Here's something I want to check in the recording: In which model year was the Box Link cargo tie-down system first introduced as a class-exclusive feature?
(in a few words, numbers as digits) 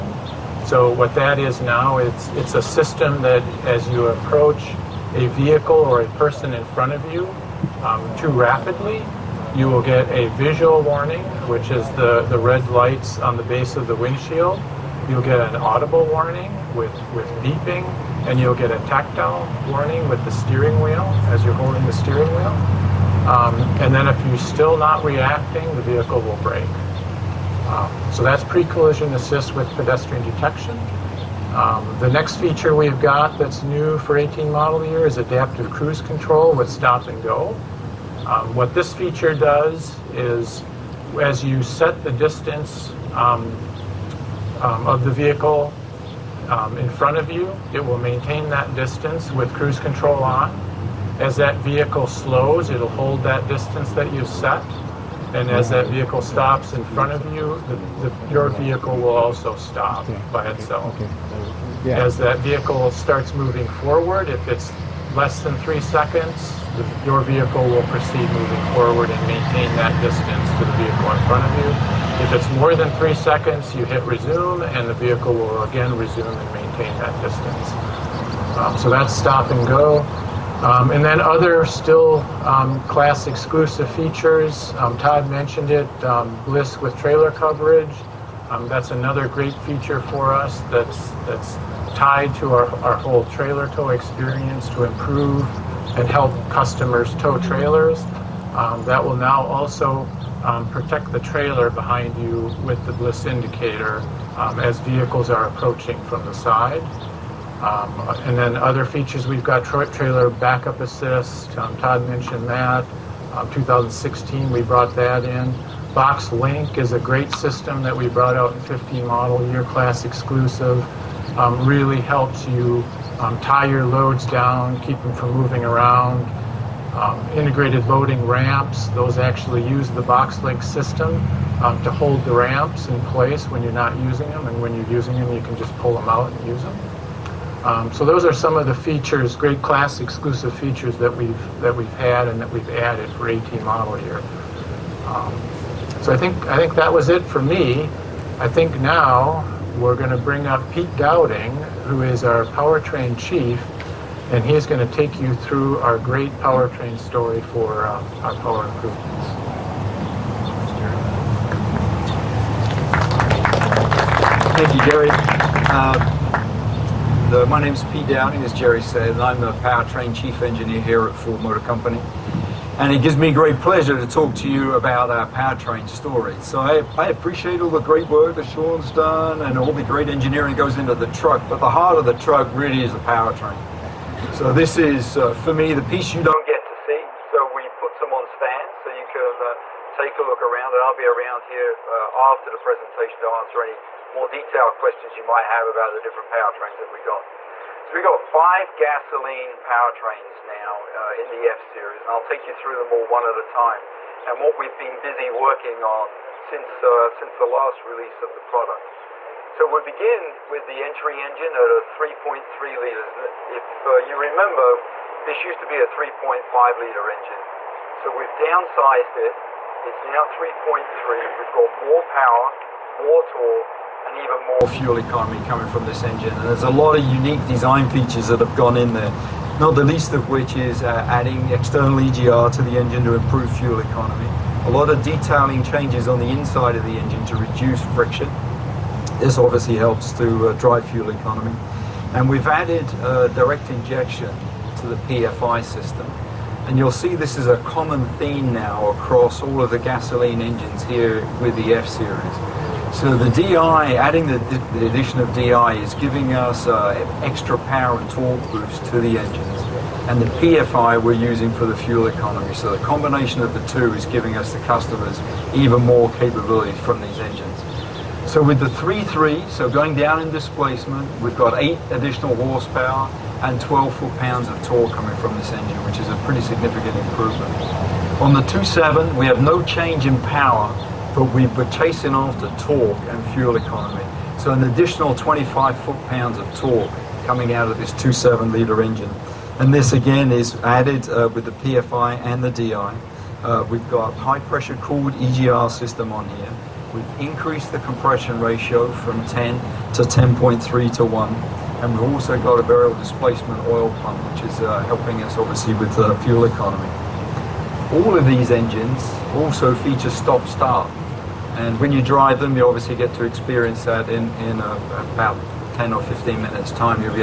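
15 model year.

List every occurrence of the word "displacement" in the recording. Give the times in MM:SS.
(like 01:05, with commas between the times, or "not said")
04:30, 05:02.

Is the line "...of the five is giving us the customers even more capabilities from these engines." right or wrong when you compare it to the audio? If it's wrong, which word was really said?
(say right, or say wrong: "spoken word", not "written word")
wrong: "two", not "five".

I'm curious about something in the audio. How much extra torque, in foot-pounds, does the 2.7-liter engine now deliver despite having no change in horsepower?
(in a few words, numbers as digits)
25 foot-pounds.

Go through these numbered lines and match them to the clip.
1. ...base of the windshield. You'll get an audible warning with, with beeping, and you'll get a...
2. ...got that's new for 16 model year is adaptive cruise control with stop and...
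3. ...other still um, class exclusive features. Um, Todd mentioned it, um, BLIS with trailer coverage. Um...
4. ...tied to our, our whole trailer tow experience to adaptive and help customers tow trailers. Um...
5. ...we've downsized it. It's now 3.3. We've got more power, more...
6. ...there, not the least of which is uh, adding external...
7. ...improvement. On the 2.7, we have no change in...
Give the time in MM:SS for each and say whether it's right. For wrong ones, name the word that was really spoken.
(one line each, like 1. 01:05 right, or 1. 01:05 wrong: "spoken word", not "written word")
1. 00:13 right
2. 00:33 wrong: "18", not "16"
3. 01:21 right
4. 01:31 wrong: "improve", not "adaptive"
5. 03:38 right
6. 03:48 right
7. 04:36 right.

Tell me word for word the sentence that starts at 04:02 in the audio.
And we've added uh, direct injection to the PFI system.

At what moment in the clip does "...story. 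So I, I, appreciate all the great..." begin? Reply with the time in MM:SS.
02:55.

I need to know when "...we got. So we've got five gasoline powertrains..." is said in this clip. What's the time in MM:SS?
03:16.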